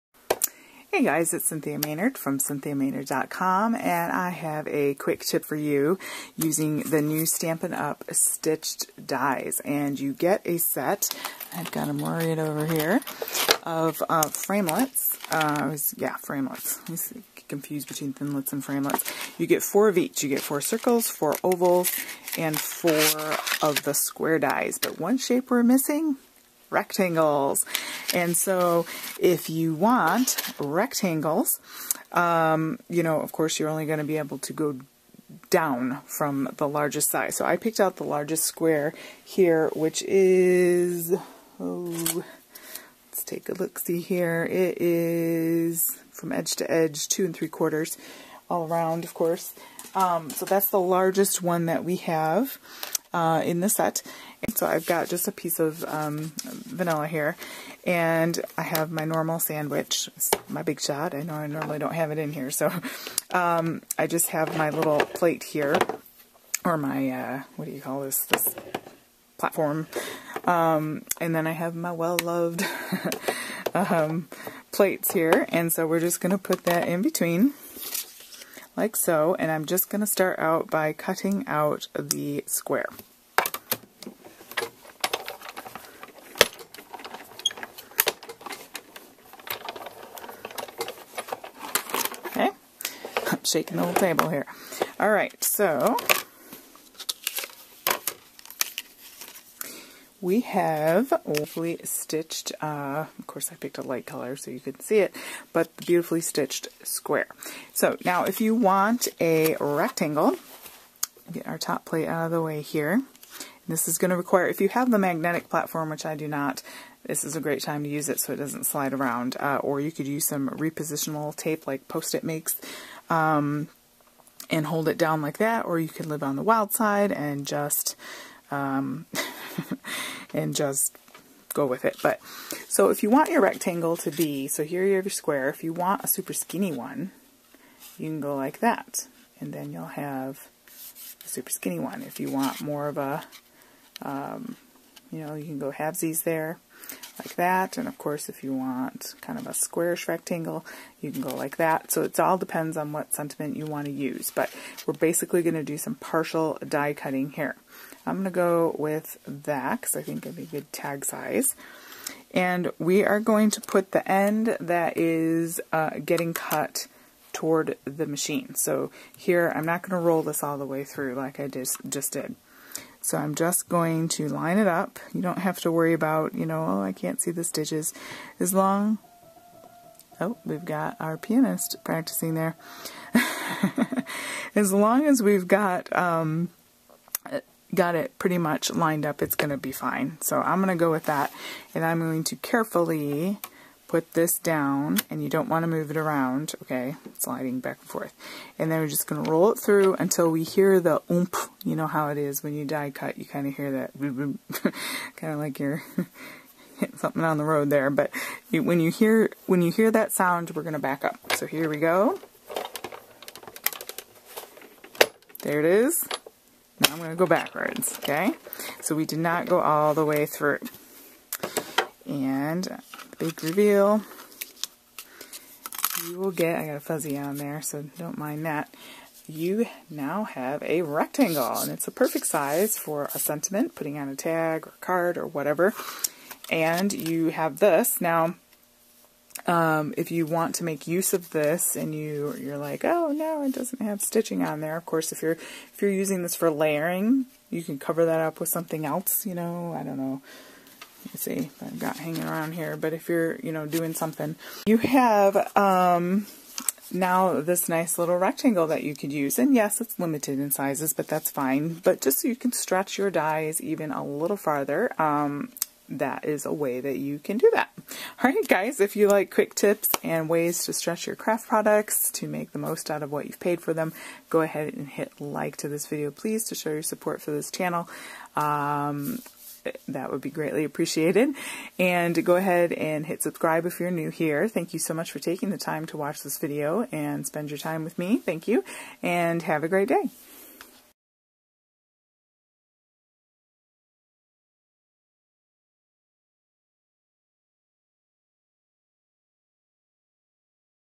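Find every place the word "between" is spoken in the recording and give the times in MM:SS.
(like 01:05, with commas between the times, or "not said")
00:17, 01:17.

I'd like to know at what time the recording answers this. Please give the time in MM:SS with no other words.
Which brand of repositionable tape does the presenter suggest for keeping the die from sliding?
02:01.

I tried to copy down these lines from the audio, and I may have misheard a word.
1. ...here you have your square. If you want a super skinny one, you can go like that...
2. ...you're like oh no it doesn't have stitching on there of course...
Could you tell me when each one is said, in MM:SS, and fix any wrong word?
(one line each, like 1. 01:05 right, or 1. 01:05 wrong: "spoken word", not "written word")
1. 02:14 right
2. 04:02 right.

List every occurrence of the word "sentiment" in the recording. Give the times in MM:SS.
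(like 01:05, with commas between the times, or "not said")
02:33, 03:53.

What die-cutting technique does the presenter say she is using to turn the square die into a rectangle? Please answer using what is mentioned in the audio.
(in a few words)
Partial die cutting.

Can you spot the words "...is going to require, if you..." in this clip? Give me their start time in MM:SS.
01:53.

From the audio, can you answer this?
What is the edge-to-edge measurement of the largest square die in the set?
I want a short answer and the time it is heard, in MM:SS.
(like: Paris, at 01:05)
2 3/4, at 00:47.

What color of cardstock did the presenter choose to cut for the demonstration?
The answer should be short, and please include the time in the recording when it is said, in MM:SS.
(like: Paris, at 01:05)
Vanilla, at 00:56.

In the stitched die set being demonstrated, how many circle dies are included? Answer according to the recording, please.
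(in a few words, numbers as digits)
4.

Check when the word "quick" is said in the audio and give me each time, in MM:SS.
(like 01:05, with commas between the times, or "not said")
00:04, 04:29.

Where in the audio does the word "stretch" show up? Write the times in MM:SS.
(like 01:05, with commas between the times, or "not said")
04:22, 04:30.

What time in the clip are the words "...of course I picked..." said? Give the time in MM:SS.
01:43.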